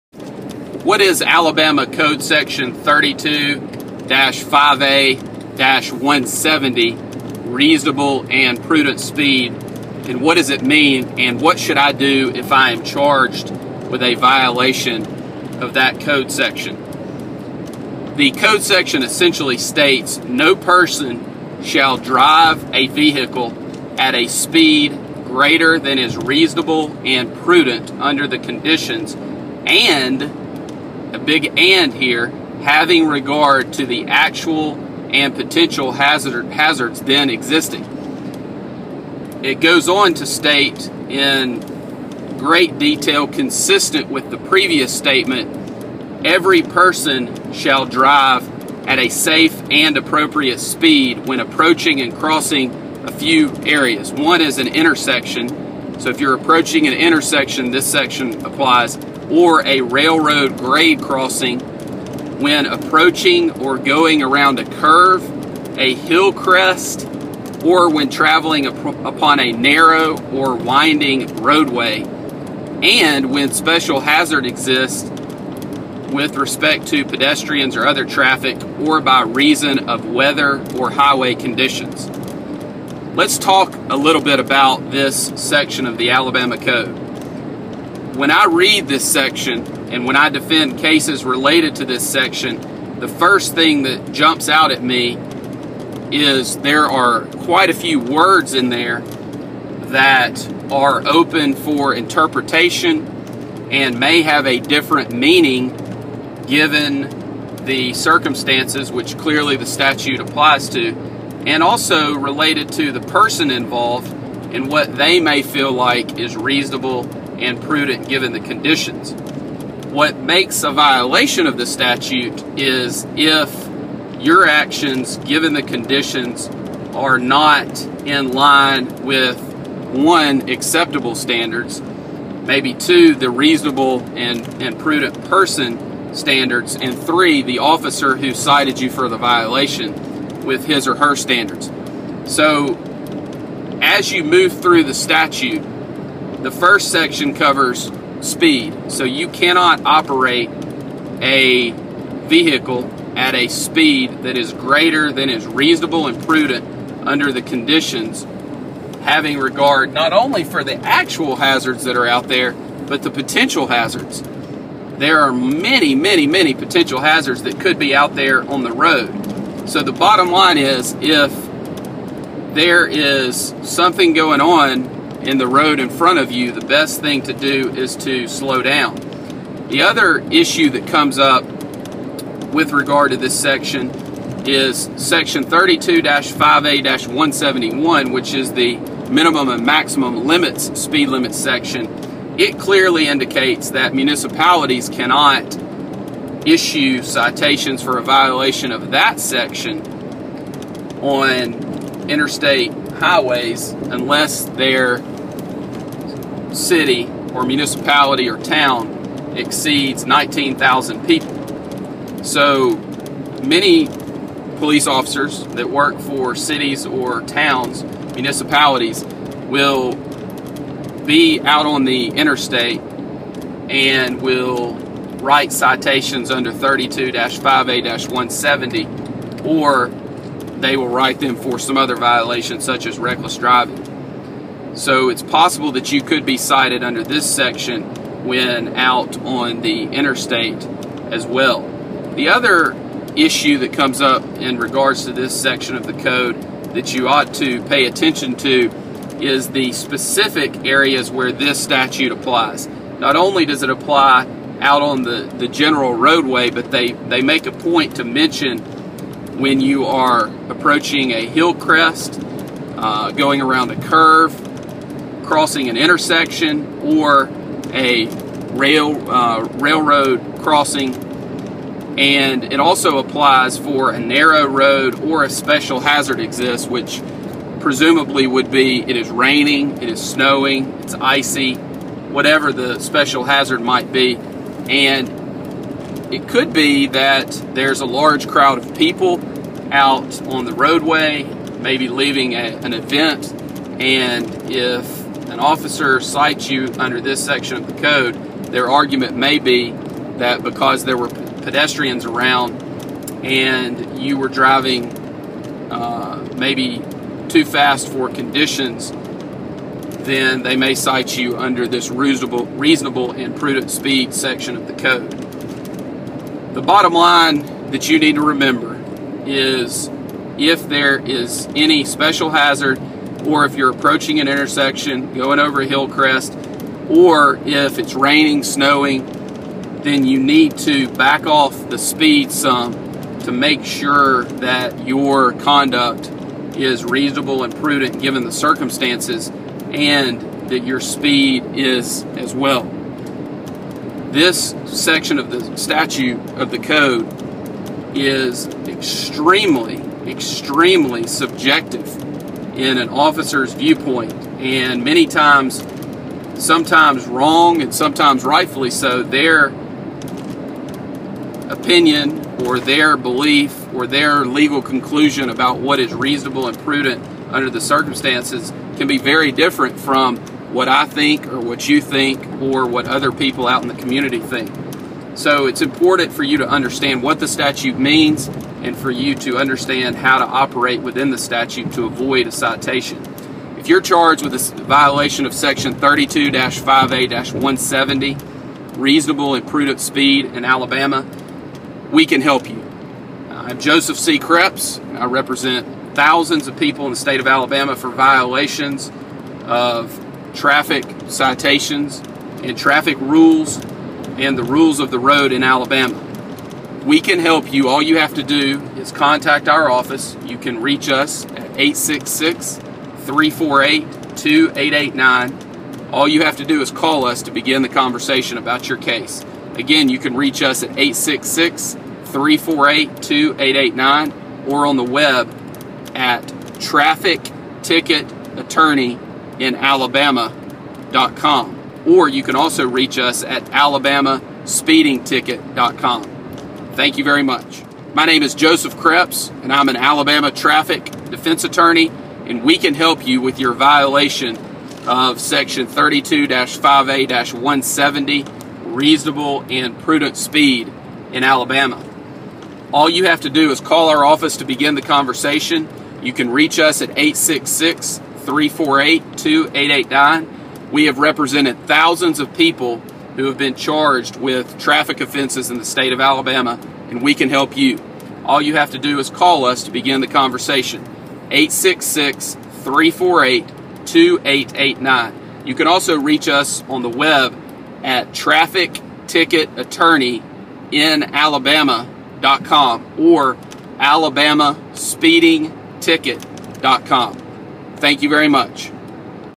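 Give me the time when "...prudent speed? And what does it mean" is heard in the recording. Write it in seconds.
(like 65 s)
8 s.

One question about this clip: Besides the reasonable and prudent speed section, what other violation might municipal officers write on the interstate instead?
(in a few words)
reckless driving.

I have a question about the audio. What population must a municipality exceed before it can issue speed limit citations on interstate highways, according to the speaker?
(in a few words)
19,000.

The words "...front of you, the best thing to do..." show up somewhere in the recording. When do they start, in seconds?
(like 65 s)
175 s.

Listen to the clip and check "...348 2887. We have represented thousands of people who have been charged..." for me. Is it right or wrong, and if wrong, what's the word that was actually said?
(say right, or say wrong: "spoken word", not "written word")
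wrong: "2889", not "2887".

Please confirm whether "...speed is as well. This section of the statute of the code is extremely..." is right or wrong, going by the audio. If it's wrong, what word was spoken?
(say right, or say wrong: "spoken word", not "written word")
right.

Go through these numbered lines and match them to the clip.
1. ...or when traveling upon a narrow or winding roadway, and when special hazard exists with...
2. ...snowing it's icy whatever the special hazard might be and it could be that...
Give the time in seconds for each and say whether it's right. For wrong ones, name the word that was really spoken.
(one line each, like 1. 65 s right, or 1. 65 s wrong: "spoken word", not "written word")
1. 67 s right
2. 280 s right.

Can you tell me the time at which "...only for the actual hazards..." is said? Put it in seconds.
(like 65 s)
160 s.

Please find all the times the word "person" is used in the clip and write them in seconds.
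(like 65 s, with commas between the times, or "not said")
20 s, 46 s, 113 s, 135 s.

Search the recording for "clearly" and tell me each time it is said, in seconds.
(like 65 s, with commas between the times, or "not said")
109 s, 192 s.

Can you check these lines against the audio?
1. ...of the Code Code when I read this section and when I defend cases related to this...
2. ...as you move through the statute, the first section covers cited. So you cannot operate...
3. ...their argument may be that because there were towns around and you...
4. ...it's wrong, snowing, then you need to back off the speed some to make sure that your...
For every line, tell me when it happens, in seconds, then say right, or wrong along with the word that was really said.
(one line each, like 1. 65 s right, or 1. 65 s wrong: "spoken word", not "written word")
1. 85 s wrong: "Alabama", not "Code"
2. 143 s wrong: "speed", not "cited"
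3. 298 s wrong: "pedestrians", not "towns"
4. 327 s wrong: "raining", not "wrong".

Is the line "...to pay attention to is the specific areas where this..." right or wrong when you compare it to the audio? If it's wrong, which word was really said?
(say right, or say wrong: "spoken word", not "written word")
right.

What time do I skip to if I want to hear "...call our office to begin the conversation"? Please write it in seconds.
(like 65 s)
453 s.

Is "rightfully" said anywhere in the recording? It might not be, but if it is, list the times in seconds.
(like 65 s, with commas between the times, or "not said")
358 s.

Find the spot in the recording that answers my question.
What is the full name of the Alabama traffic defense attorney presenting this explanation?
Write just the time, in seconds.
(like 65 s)
393 s.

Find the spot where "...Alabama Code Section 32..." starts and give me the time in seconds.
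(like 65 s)
1 s.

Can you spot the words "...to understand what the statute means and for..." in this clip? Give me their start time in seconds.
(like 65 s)
376 s.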